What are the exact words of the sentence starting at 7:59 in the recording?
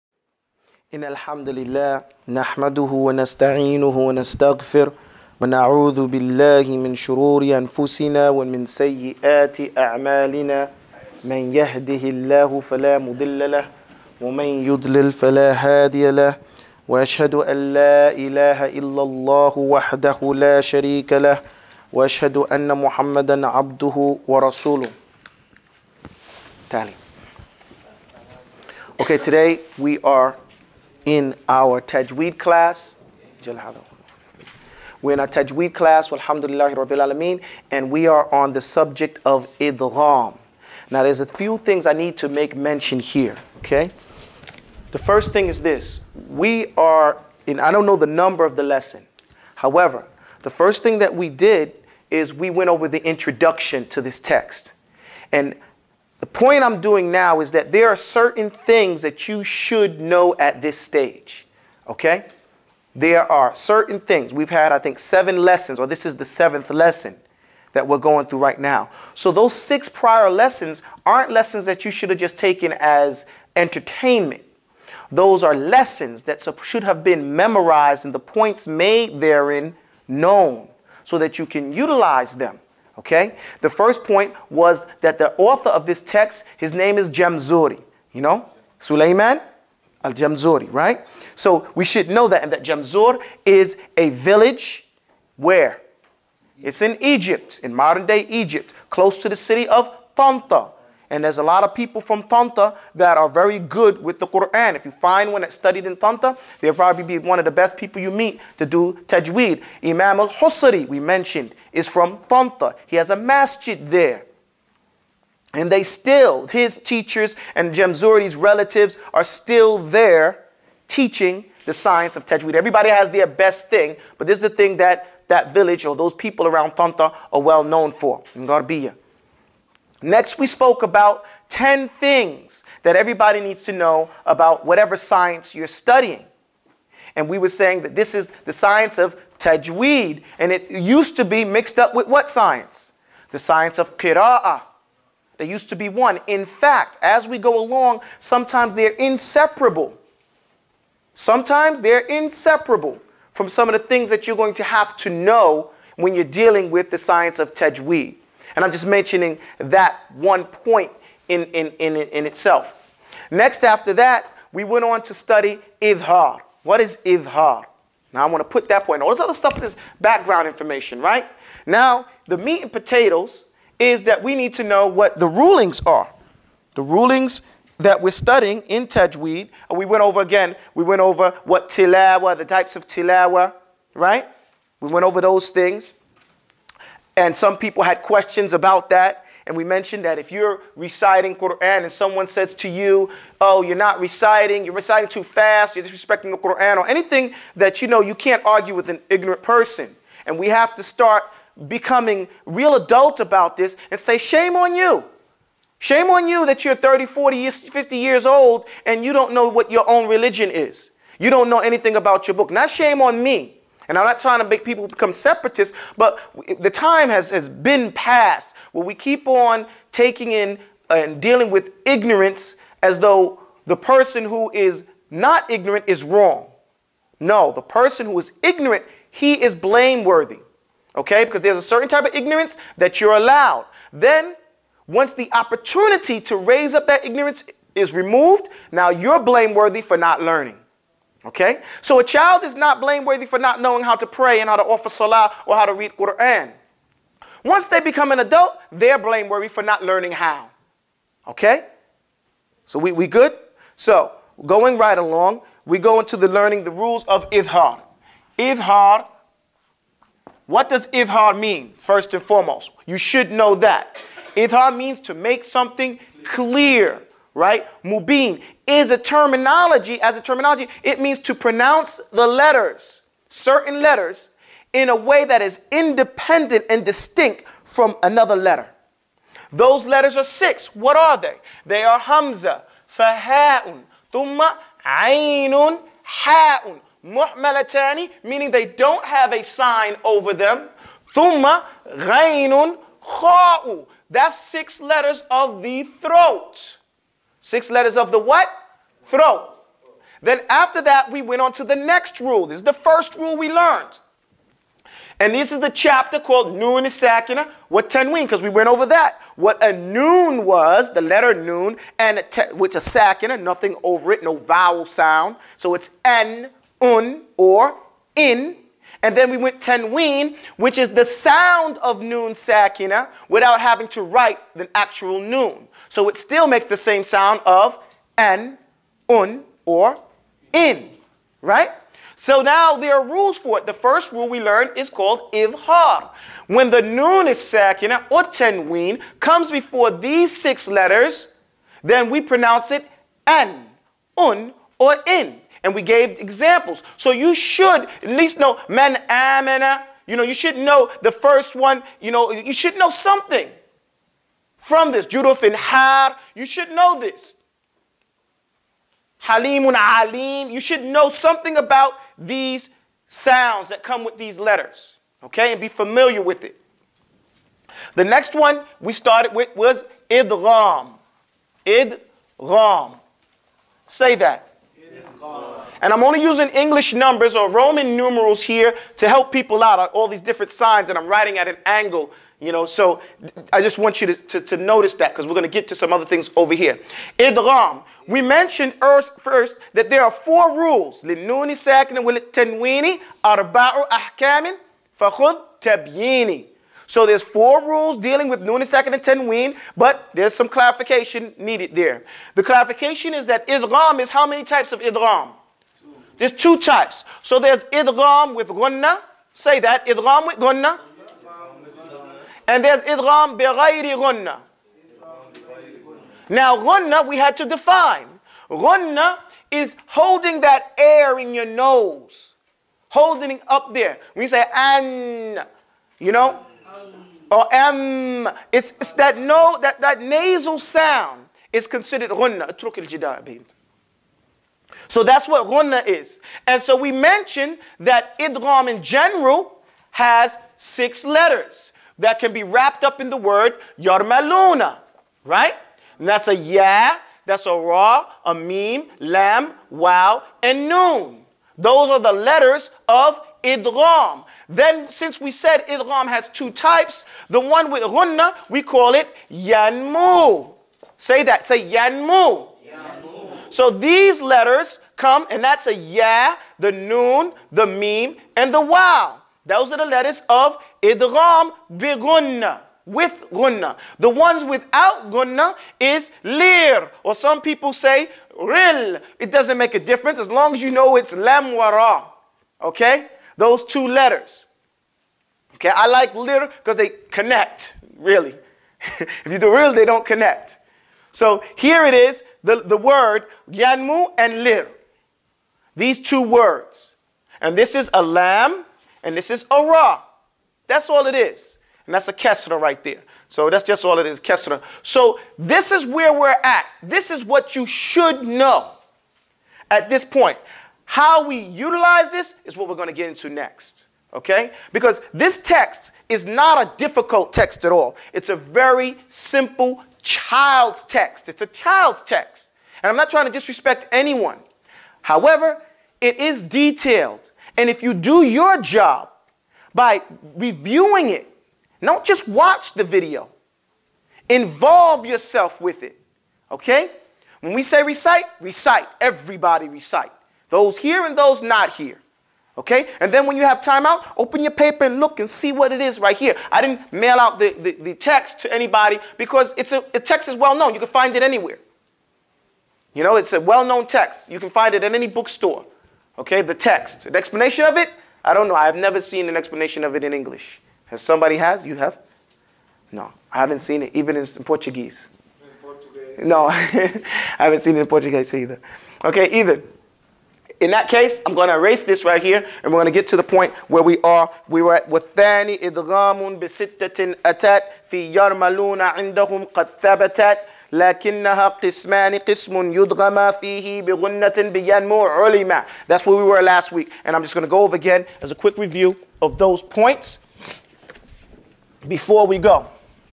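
It doesn't make a difference as long as you know it's lam wara.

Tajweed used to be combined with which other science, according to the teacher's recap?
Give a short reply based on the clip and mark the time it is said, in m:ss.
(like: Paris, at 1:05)
qira'ah, at 2:23.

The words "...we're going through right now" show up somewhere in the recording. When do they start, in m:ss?
1:07.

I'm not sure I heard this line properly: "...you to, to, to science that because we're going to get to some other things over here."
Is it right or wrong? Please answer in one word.
wrong.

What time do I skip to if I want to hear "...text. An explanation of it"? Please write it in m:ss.
9:16.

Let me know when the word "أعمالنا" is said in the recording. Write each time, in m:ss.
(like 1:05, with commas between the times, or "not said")
0:09.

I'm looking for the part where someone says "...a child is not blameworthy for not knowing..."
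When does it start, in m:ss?
4:01.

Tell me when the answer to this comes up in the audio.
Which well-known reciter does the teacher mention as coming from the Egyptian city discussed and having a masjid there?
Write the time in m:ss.
1:49.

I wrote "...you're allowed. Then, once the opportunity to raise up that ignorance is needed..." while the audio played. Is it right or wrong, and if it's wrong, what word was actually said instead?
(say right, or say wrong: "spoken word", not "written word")
wrong: "removed", not "needed".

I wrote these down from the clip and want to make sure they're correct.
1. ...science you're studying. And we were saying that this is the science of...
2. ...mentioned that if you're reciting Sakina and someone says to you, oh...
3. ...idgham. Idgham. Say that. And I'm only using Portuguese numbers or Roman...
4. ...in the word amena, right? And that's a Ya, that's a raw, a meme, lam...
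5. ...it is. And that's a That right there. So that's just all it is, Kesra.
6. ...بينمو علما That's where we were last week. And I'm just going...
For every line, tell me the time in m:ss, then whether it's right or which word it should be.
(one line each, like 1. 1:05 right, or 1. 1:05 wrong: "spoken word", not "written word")
1. 2:14 right
2. 3:09 wrong: "Quran", not "Sakina"
3. 6:10 wrong: "English", not "Portuguese"
4. 7:22 wrong: "yarmaluna", not "amena"
5. 8:21 wrong: "Kesra", not "That"
6. 9:44 right.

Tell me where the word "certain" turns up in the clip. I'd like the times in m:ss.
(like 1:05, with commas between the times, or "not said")
0:57, 1:03, 3:51, 4:33.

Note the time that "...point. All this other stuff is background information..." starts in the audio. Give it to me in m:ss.
2:48.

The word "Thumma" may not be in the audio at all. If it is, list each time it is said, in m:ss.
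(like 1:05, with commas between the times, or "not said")
4:44, 4:51.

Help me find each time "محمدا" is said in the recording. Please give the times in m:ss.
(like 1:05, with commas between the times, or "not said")
0:22.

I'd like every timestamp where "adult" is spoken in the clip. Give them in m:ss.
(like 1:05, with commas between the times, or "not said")
3:22, 4:08.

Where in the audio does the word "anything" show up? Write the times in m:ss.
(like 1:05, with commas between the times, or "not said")
3:16, 3:31.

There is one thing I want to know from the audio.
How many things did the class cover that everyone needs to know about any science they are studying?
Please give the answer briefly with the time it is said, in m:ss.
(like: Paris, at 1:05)
10, at 2:11.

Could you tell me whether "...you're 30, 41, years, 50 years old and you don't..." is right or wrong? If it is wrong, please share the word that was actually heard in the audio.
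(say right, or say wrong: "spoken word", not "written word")
wrong: "40", not "41".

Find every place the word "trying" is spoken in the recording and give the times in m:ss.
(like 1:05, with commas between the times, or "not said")
3:34, 8:43.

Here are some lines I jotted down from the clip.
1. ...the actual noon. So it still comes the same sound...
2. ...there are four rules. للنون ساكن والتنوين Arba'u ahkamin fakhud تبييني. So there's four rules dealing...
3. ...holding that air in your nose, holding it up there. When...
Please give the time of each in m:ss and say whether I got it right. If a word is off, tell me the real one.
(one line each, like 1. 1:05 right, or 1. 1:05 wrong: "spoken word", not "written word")
1. 5:24 wrong: "makes", not "comes"
2. 6:29 right
3. 6:59 right.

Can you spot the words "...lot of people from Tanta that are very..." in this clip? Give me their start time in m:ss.
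1:41.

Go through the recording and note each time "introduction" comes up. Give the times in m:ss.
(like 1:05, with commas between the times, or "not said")
0:53.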